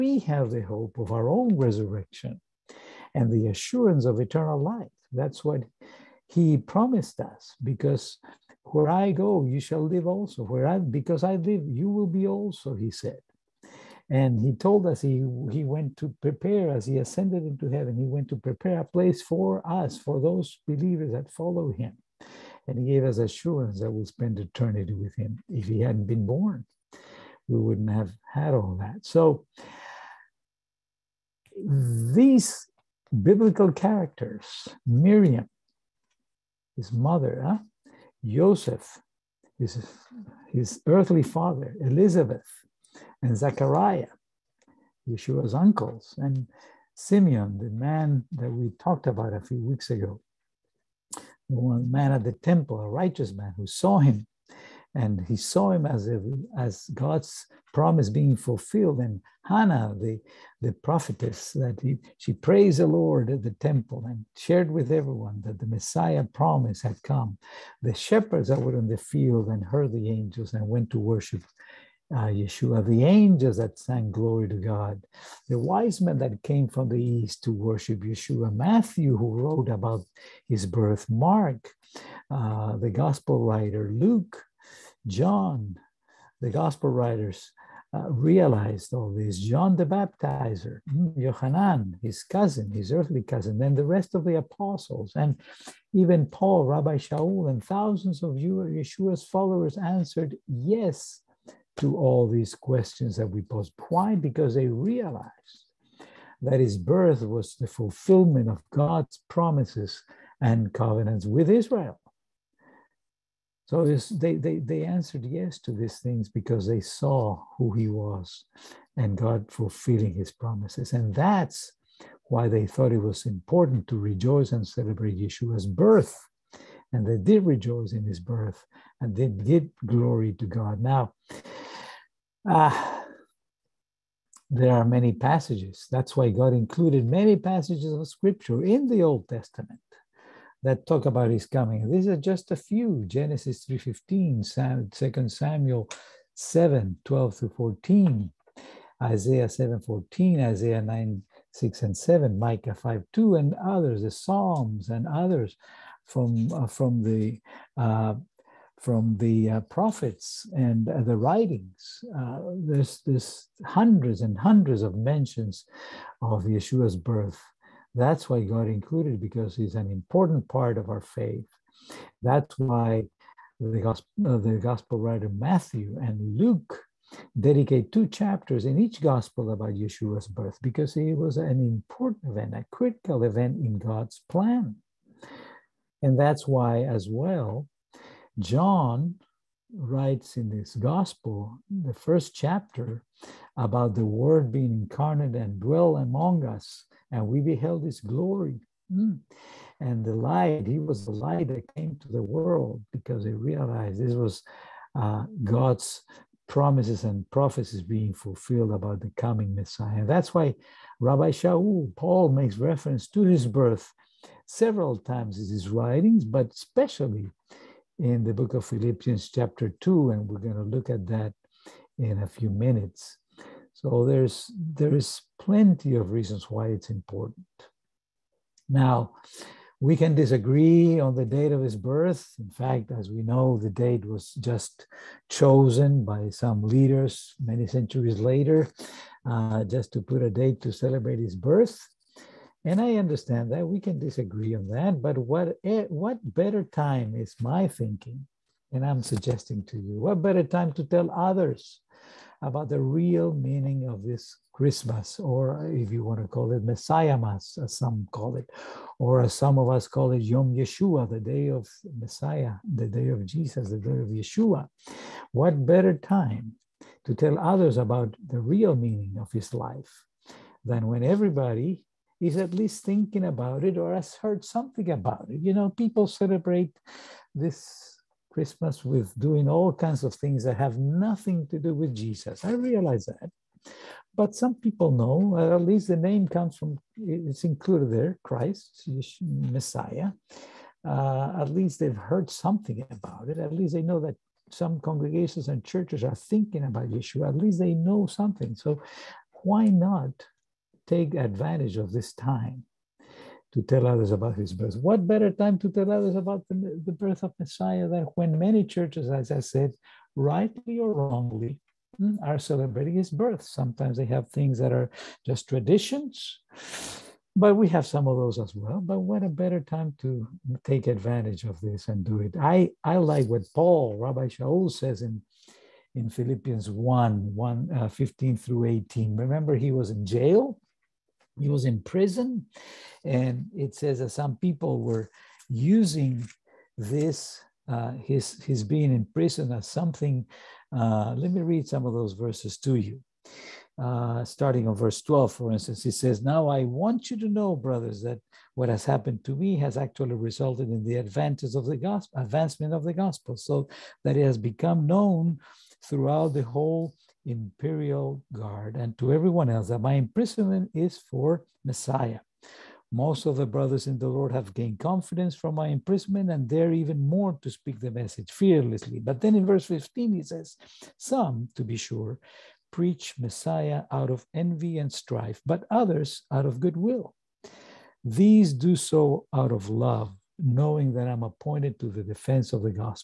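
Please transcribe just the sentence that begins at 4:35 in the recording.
You know, people celebrate this Christmas with doing all kinds of things that have nothing to do with Jesus.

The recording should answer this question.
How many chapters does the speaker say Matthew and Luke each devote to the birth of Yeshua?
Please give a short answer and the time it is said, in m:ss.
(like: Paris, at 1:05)
2, at 2:57.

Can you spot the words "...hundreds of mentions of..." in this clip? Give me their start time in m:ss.
2:44.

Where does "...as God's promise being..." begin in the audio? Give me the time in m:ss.
0:56.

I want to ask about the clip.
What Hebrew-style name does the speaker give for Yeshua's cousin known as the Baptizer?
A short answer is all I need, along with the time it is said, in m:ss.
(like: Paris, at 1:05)
Yohanan, at 1:31.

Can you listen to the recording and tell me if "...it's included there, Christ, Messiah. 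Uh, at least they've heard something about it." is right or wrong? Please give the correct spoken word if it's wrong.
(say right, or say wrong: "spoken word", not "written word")
right.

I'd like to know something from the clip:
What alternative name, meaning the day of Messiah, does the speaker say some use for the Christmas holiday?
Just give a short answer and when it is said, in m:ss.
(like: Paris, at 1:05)
Yom Yeshua, at 4:20.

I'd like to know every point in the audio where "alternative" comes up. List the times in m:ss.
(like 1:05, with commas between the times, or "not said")
not said.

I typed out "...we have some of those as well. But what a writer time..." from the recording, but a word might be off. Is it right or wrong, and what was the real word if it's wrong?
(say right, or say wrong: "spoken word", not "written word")
wrong: "better", not "writer".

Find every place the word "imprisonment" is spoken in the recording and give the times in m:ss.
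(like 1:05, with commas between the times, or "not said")
5:59, 6:05.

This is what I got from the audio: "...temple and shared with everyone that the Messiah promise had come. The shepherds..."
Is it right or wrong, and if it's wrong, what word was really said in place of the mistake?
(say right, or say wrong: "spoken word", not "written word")
right.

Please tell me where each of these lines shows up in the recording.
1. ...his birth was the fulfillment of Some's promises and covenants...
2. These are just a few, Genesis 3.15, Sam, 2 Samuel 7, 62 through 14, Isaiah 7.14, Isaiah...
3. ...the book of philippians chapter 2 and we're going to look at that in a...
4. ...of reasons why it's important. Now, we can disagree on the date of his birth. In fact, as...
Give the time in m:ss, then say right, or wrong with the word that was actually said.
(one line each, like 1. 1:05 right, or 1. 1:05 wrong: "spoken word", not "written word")
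1. 1:46 wrong: "God", not "Some"
2. 2:21 wrong: "12", not "62"
3. 3:38 right
4. 3:45 right.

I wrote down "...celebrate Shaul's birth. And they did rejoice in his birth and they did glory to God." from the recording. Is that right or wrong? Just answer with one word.
wrong.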